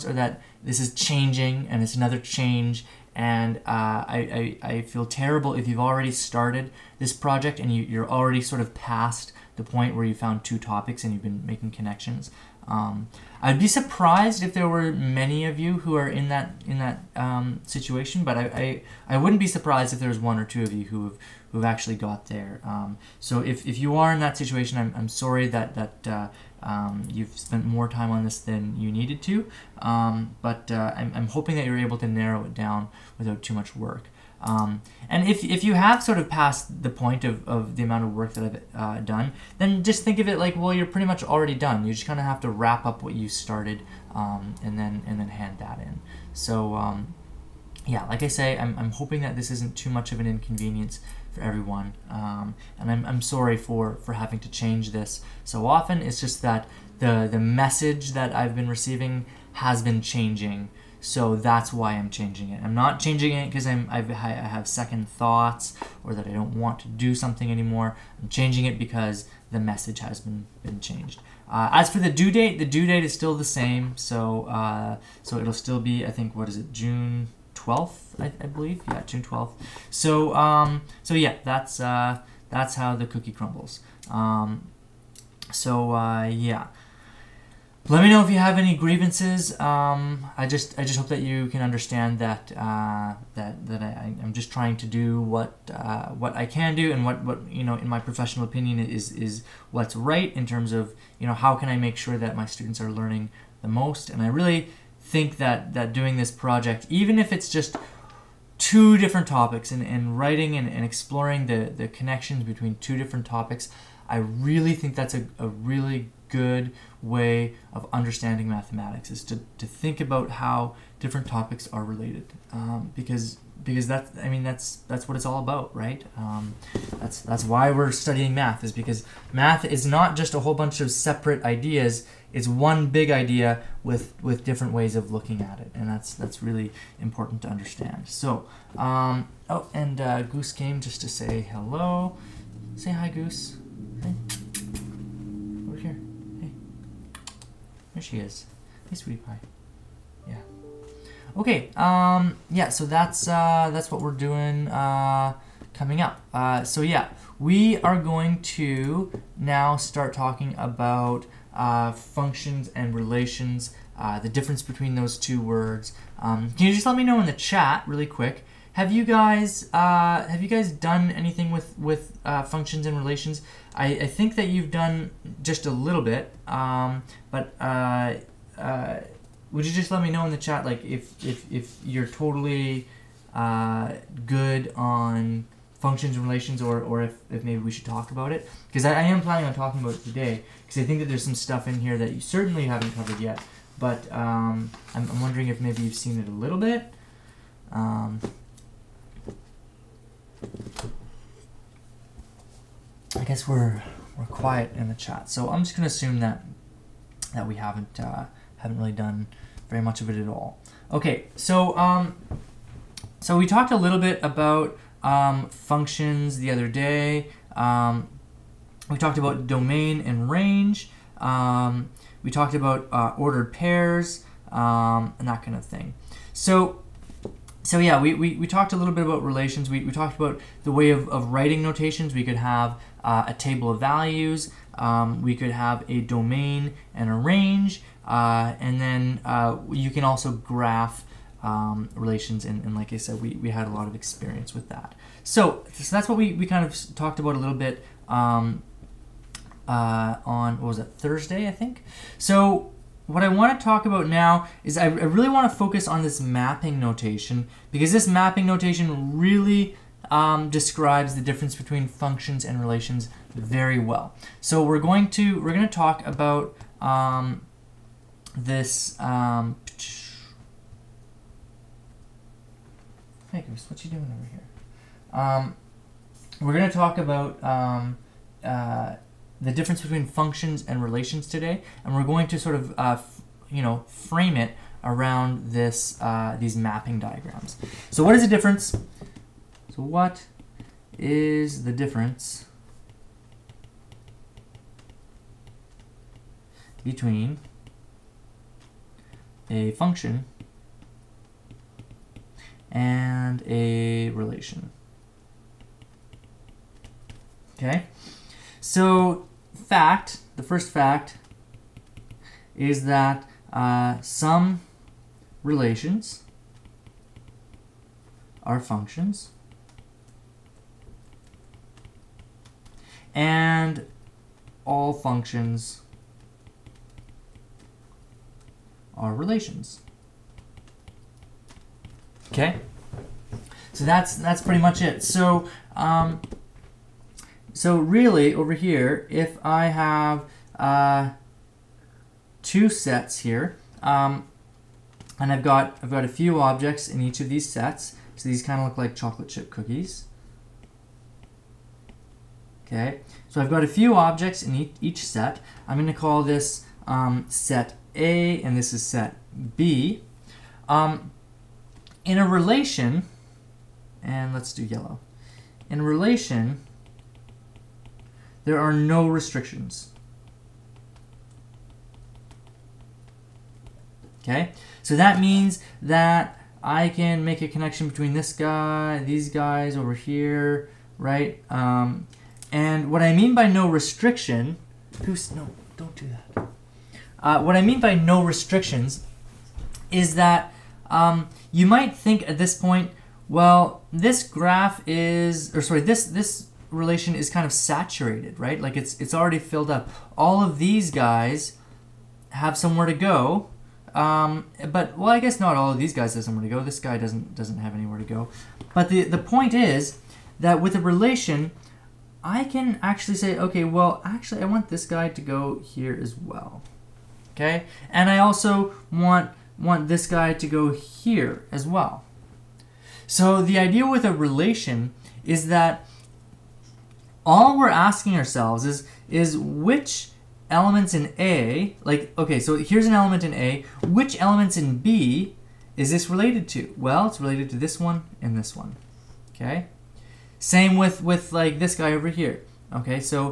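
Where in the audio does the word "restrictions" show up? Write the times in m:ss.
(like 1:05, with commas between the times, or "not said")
6:09, 6:23, 6:28.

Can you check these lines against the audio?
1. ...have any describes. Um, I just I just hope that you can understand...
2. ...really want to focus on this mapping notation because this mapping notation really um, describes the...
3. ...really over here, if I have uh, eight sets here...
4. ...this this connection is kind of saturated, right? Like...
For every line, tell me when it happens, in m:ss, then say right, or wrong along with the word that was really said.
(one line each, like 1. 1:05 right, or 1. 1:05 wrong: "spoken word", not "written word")
1. 1:28 wrong: "grievances", not "describes"
2. 4:14 right
3. 5:37 wrong: "two", not "eight"
4. 6:35 wrong: "relation", not "connection".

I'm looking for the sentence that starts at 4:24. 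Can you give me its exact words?
So we're going to we're going to talk about um, this um, Hey Goose, what you doing over here?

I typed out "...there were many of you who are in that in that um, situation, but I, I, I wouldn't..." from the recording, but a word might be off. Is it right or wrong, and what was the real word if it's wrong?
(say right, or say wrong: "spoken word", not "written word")
right.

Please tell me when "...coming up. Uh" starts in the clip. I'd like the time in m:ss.
2:35.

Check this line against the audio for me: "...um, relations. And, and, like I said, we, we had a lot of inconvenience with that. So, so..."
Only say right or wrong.
wrong.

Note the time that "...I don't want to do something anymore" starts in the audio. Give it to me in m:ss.
1:06.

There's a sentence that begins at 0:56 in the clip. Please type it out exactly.
It's just that the, the message that I've been receiving has been changing.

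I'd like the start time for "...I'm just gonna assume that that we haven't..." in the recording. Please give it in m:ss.
3:25.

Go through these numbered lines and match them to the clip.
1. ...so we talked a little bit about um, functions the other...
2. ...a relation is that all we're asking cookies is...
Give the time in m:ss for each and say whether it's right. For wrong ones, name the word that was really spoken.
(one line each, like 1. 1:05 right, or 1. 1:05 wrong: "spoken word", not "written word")
1. 3:33 right
2. 7:04 wrong: "ourselves", not "cookies".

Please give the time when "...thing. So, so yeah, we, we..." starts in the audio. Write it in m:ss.
3:45.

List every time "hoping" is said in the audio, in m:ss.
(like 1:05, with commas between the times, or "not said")
0:31, 0:48.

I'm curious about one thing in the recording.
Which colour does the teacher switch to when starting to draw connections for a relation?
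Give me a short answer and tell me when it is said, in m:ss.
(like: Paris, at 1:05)
yellow, at 6:04.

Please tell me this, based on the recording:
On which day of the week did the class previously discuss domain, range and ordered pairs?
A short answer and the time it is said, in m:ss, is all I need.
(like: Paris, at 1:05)
Thursday, at 4:10.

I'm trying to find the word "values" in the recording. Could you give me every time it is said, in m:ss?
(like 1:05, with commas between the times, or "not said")
3:53.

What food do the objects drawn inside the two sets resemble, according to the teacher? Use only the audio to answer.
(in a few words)
chocolate chip cookies.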